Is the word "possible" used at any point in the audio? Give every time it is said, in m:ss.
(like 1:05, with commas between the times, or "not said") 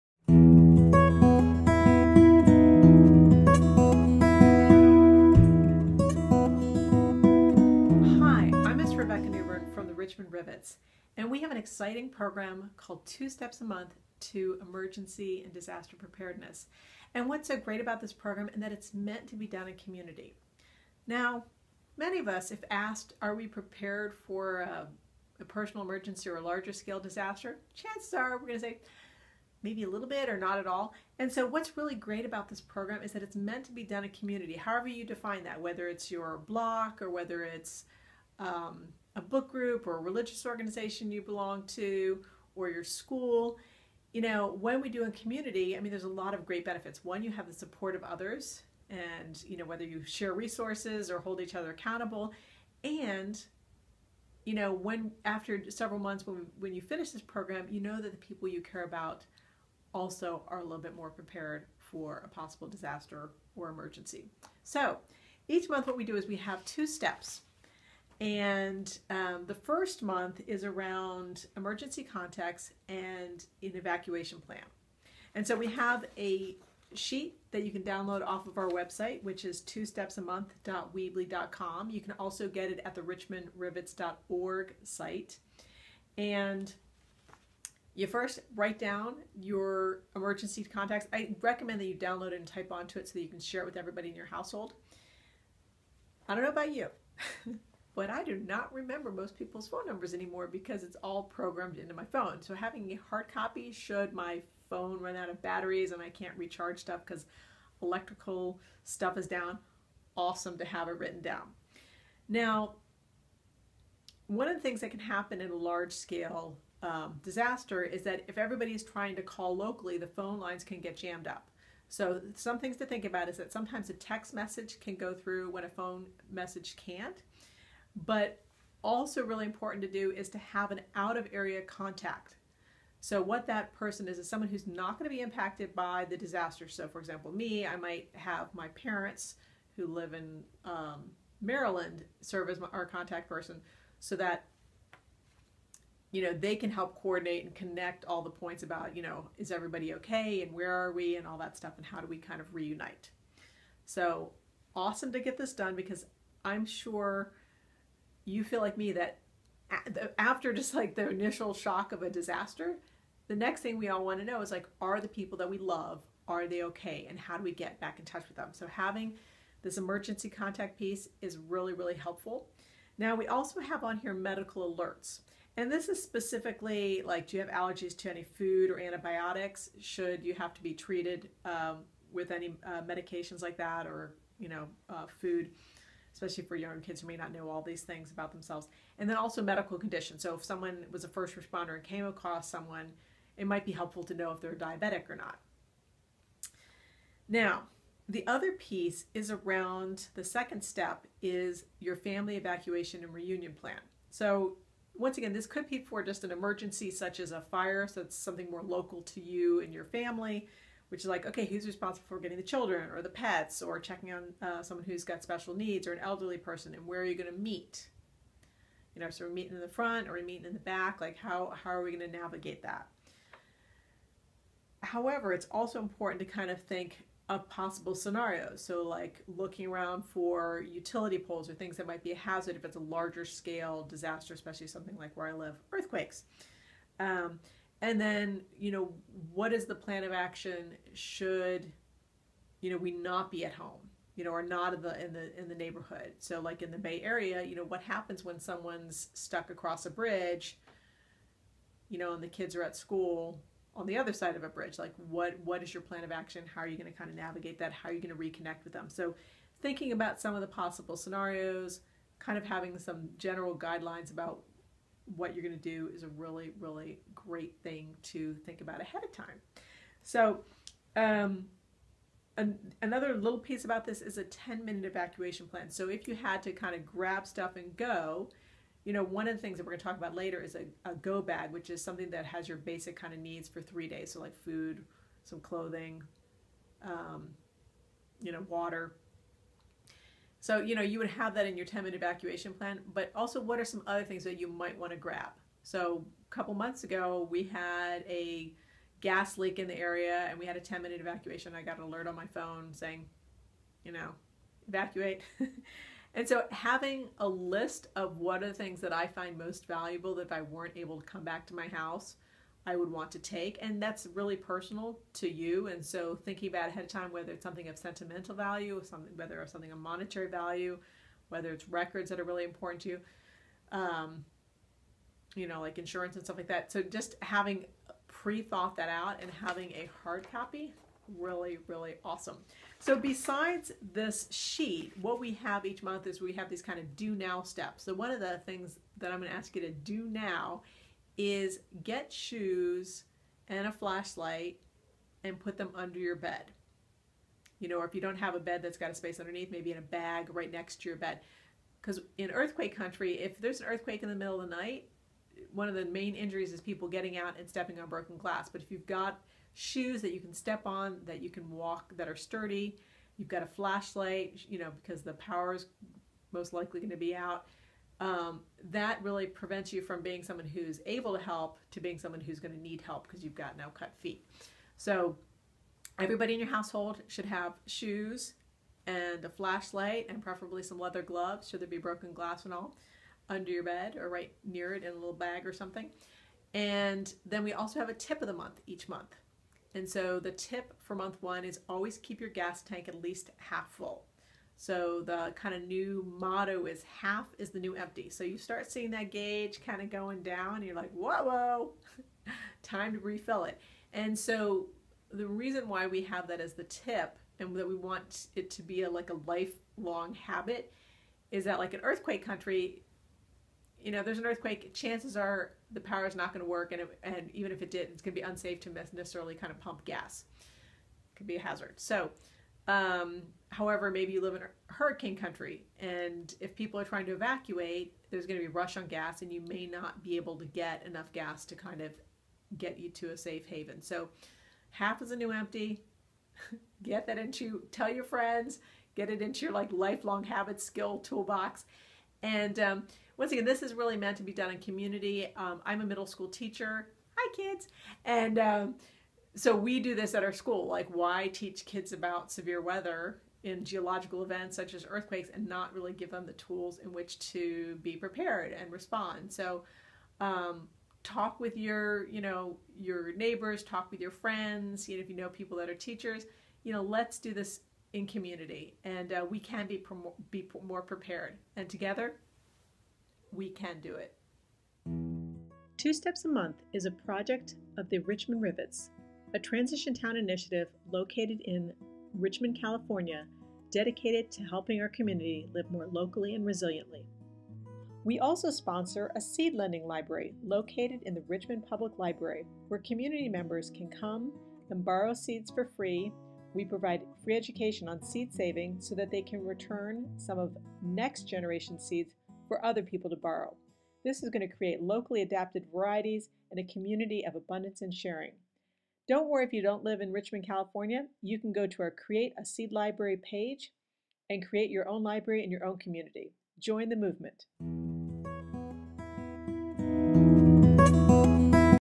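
1:02, 3:47, 4:20.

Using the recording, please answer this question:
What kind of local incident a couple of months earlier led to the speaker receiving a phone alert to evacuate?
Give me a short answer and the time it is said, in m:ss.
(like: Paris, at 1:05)
Gas leak, at 4:59.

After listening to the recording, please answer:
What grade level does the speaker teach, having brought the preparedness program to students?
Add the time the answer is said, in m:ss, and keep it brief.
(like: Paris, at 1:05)
Middle school, at 7:25.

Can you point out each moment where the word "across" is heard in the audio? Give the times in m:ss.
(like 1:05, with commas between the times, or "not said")
3:12, 4:09.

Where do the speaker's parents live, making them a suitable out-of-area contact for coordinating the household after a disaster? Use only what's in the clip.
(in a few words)
Maryland.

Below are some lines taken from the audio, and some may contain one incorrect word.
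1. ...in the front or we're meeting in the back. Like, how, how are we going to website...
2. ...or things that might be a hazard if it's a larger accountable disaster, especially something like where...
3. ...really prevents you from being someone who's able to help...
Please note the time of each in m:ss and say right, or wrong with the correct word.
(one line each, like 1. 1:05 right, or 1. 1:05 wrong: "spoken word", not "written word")
1. 3:39 wrong: "navigate", not "website"
2. 3:51 wrong: "scale", not "accountable"
3. 6:09 right.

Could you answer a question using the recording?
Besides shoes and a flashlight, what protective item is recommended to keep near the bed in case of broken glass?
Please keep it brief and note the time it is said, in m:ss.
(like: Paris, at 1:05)
Leather gloves, at 6:20.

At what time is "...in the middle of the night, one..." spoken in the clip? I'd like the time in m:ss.
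5:54.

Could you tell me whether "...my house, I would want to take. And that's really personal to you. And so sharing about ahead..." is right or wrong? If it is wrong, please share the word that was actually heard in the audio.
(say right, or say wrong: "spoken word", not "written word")
wrong: "thinking", not "sharing".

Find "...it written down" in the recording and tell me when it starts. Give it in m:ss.
1:50.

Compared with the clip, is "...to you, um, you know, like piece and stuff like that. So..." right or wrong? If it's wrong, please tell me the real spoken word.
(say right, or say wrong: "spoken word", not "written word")
wrong: "insurance", not "piece".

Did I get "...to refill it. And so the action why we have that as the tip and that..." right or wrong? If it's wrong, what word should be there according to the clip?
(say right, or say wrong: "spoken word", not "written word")
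wrong: "reason", not "action".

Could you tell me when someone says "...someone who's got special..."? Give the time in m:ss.
3:34.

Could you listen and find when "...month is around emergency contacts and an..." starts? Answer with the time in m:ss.
1:10.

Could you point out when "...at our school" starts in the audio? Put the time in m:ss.
7:30.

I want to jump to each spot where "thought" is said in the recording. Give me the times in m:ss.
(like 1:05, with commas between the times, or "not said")
5:28.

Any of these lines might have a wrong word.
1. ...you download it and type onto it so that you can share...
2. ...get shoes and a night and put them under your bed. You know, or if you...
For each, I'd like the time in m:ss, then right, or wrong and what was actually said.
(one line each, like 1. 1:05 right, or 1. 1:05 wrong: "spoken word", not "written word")
1. 1:31 right
2. 5:41 wrong: "flashlight", not "night".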